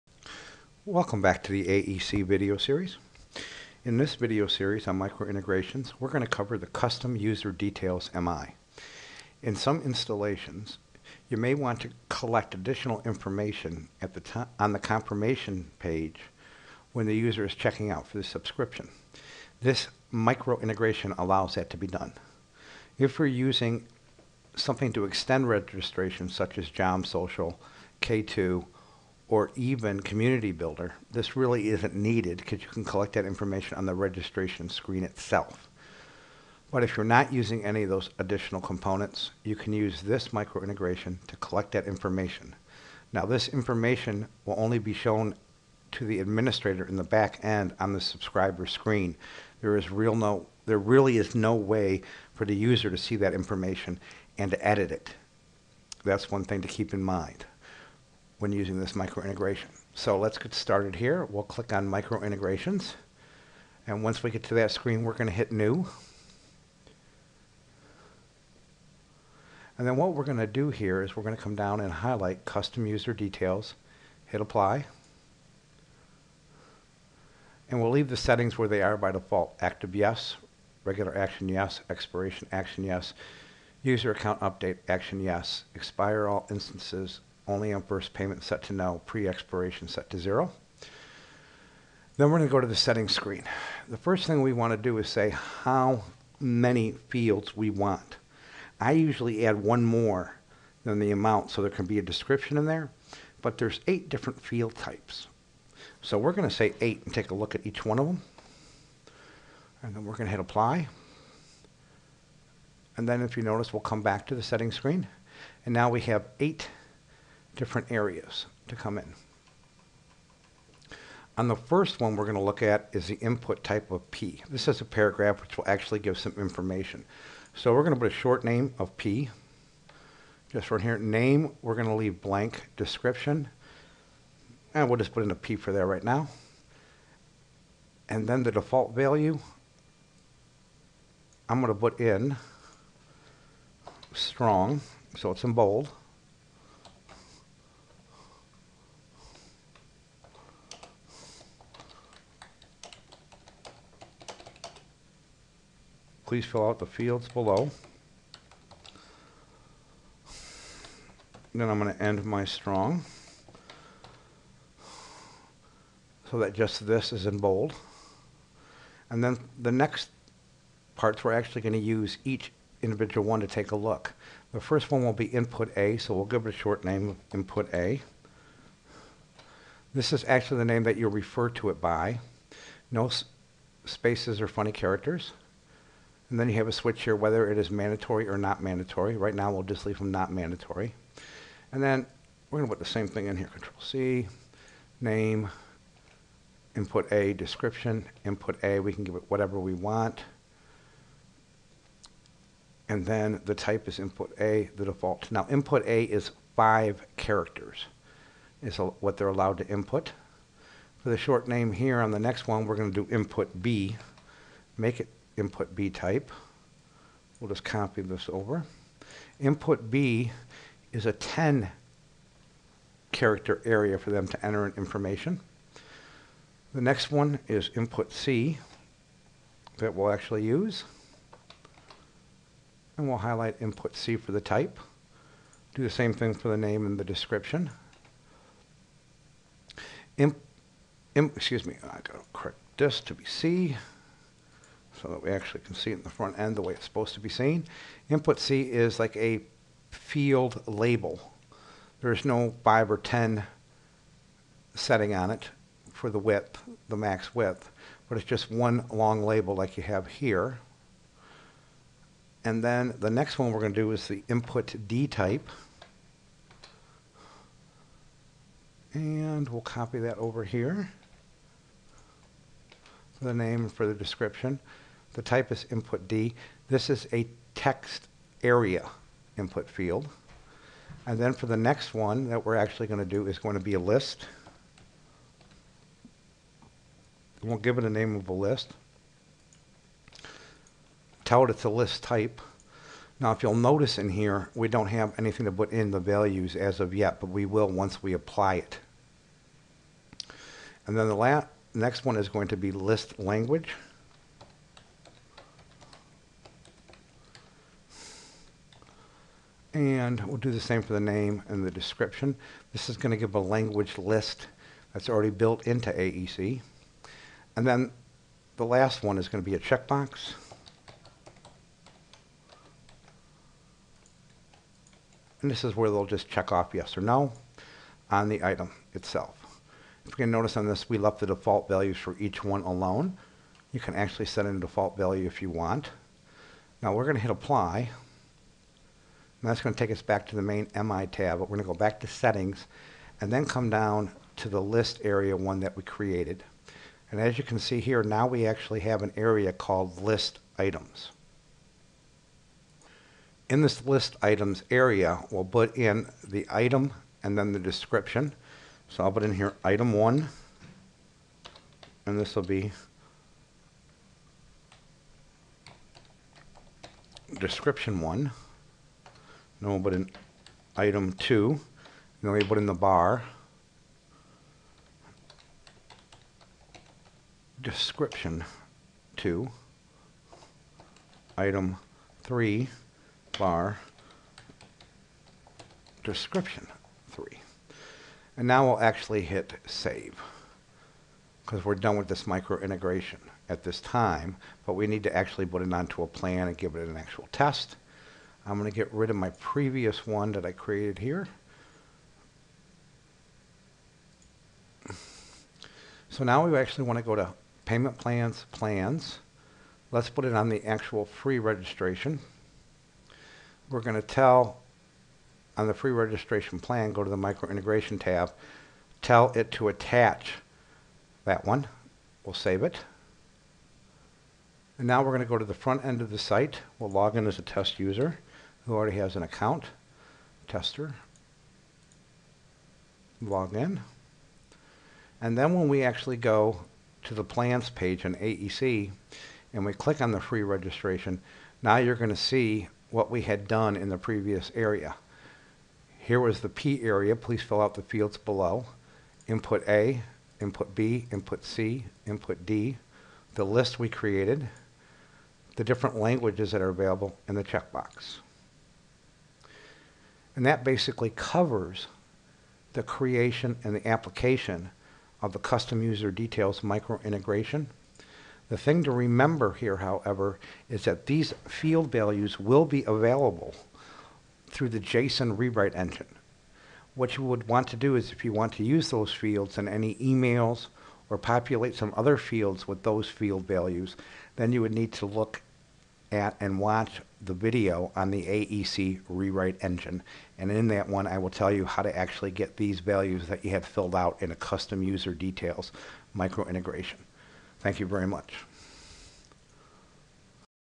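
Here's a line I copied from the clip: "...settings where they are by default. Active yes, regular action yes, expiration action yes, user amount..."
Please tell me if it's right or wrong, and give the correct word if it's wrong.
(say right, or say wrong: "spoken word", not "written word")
wrong: "account", not "amount".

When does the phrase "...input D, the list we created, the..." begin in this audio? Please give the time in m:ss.
7:32.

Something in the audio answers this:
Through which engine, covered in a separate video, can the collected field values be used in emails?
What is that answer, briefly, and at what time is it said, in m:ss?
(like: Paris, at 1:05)
JSON rewrite engine, at 7:54.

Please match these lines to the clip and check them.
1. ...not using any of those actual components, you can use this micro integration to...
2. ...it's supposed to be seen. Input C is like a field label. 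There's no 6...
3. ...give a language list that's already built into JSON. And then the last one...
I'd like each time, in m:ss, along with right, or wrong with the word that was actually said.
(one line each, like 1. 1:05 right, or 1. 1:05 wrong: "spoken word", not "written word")
1. 0:37 wrong: "additional", not "actual"
2. 4:06 wrong: "5", not "6"
3. 5:13 wrong: "AEC", not "JSON".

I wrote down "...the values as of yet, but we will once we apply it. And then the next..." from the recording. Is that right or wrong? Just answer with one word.
right.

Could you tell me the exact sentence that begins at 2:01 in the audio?
On the first one we're going to look at is the input type of P.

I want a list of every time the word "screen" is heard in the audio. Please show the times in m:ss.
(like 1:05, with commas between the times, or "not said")
0:34, 0:48, 1:04, 1:33, 1:54.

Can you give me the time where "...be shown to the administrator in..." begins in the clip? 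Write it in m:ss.
0:44.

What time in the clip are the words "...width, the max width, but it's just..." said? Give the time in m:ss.
4:16.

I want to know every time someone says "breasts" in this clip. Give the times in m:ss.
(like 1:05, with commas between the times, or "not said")
not said.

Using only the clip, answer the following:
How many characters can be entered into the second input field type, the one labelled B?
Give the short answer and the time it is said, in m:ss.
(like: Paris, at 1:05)
10, at 3:41.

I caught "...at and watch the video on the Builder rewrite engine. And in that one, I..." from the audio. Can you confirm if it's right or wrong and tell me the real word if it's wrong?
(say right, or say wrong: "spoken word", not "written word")
wrong: "AEC", not "Builder".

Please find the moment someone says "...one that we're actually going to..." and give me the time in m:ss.
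4:41.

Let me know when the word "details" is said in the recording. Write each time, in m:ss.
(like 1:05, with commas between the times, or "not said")
0:07, 1:13, 7:46, 8:15.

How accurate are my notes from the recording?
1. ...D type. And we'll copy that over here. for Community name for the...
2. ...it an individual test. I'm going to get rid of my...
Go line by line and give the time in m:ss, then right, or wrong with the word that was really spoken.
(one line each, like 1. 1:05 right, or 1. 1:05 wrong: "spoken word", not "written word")
1. 4:24 wrong: "The", not "Community"
2. 6:36 wrong: "actual", not "individual".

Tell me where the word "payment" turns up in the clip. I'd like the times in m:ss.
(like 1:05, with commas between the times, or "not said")
1:28, 6:47.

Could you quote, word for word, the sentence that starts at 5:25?
And this is where they'll just check off yes or no on the item itself.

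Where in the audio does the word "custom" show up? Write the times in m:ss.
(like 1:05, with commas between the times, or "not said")
0:06, 1:12, 7:45, 8:14.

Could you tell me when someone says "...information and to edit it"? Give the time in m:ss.
0:53.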